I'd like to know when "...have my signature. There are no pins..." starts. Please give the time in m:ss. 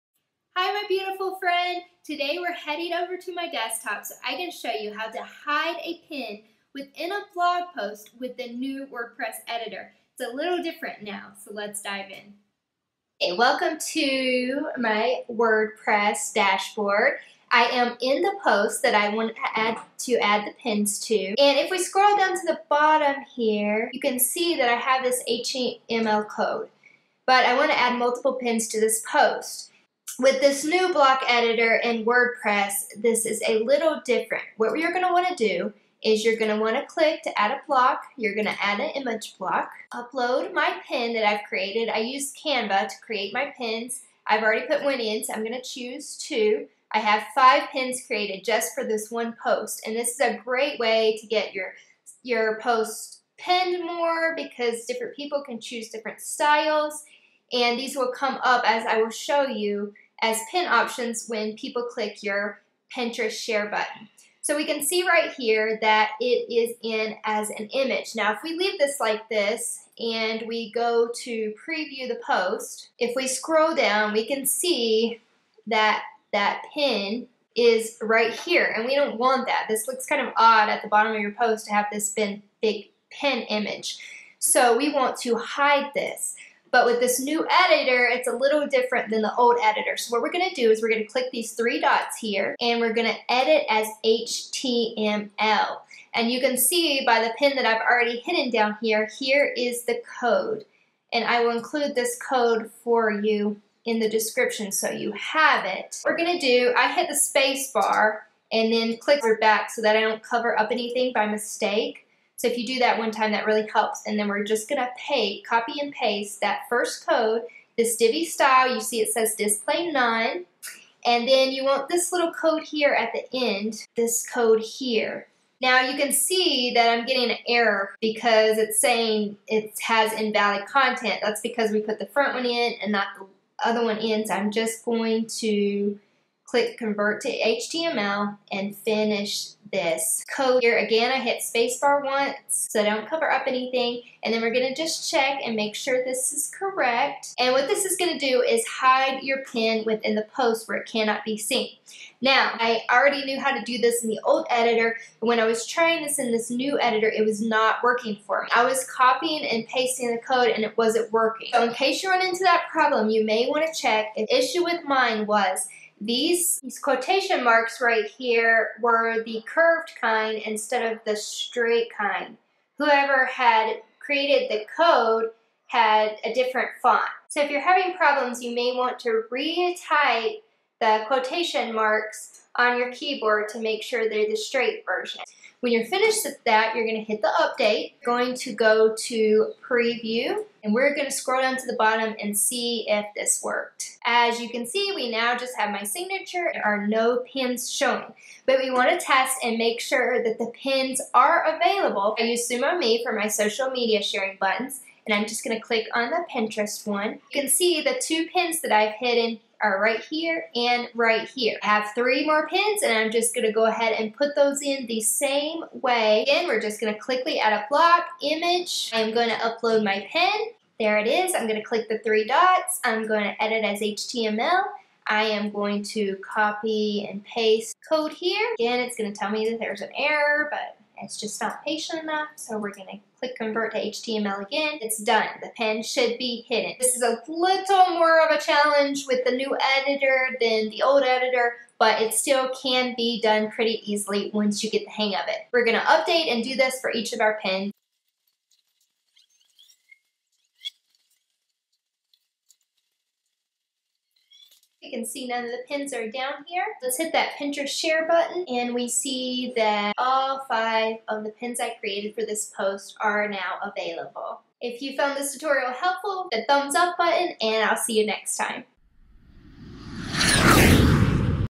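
3:15.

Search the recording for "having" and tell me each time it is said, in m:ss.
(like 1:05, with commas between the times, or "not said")
2:57.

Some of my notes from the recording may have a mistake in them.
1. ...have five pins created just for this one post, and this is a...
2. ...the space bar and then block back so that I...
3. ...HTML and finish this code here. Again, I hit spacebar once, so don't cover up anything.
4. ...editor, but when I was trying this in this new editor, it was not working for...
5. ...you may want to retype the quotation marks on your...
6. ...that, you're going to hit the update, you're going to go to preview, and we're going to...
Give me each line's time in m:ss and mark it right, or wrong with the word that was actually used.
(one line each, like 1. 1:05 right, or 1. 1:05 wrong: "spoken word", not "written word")
1. 0:46 right
2. 1:47 wrong: "click", not "block"
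3. 2:17 right
4. 2:34 right
5. 2:58 right
6. 3:06 right.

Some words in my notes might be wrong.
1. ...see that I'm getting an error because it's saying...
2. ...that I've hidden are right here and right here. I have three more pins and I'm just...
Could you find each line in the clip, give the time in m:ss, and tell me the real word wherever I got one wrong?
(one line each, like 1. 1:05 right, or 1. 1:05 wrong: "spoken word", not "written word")
1. 2:06 right
2. 3:28 right.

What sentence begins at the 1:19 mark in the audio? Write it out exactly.
This looks kind of odd at the bottom of your post to have this big pin image.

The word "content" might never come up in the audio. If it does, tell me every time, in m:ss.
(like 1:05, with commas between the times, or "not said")
2:10.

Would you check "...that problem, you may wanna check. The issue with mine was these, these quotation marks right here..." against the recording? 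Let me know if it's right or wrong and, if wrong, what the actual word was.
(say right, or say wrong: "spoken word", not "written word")
right.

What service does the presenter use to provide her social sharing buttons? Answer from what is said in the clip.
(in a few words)
SumoMe.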